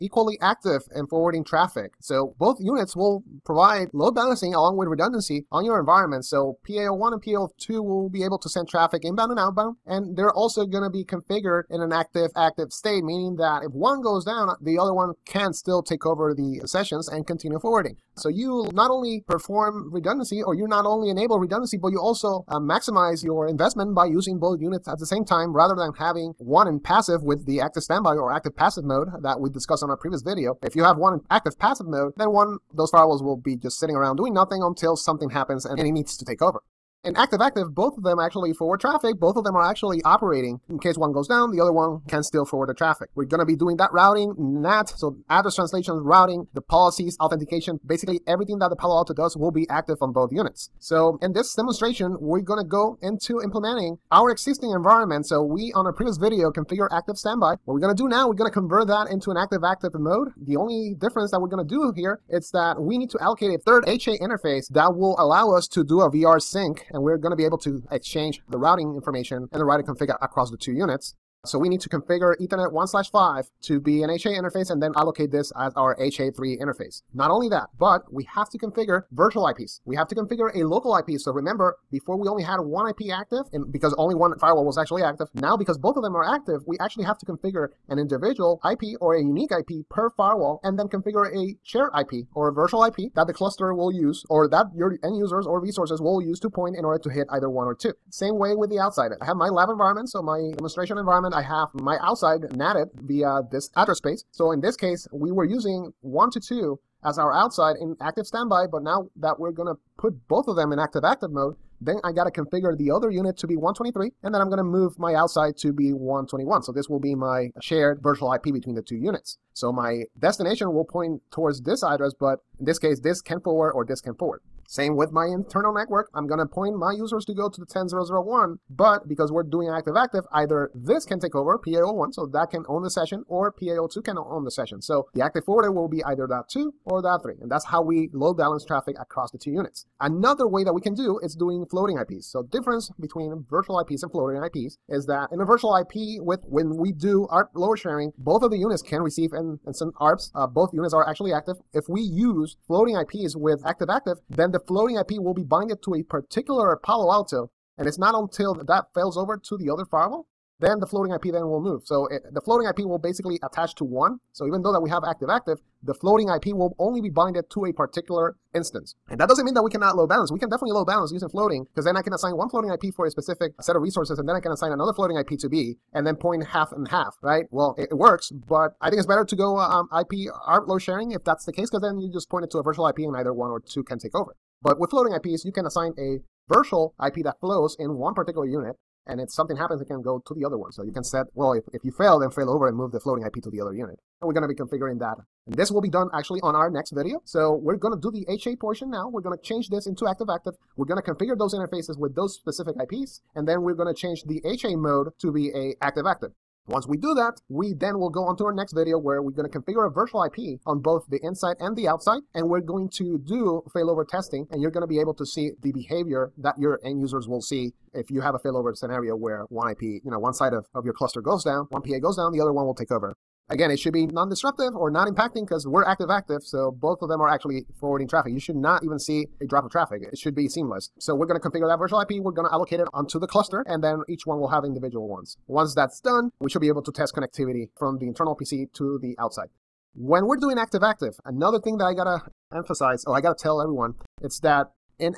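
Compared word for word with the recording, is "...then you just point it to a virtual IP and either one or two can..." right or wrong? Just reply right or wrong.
right.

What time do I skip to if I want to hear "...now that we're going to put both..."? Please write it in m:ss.
1:48.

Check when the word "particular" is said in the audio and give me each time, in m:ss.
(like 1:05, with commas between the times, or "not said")
2:36, 2:47, 3:08.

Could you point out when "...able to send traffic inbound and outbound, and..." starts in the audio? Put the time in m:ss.
0:08.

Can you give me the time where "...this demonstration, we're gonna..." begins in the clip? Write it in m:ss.
0:51.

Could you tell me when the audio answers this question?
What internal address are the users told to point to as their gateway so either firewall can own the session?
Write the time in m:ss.
2:07.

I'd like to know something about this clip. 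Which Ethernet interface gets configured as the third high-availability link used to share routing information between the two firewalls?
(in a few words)
Ethernet 1/5.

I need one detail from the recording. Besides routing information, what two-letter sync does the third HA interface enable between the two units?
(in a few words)
VR sync.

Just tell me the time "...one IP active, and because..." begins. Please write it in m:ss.
1:22.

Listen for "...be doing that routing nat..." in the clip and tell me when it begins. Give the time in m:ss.
0:43.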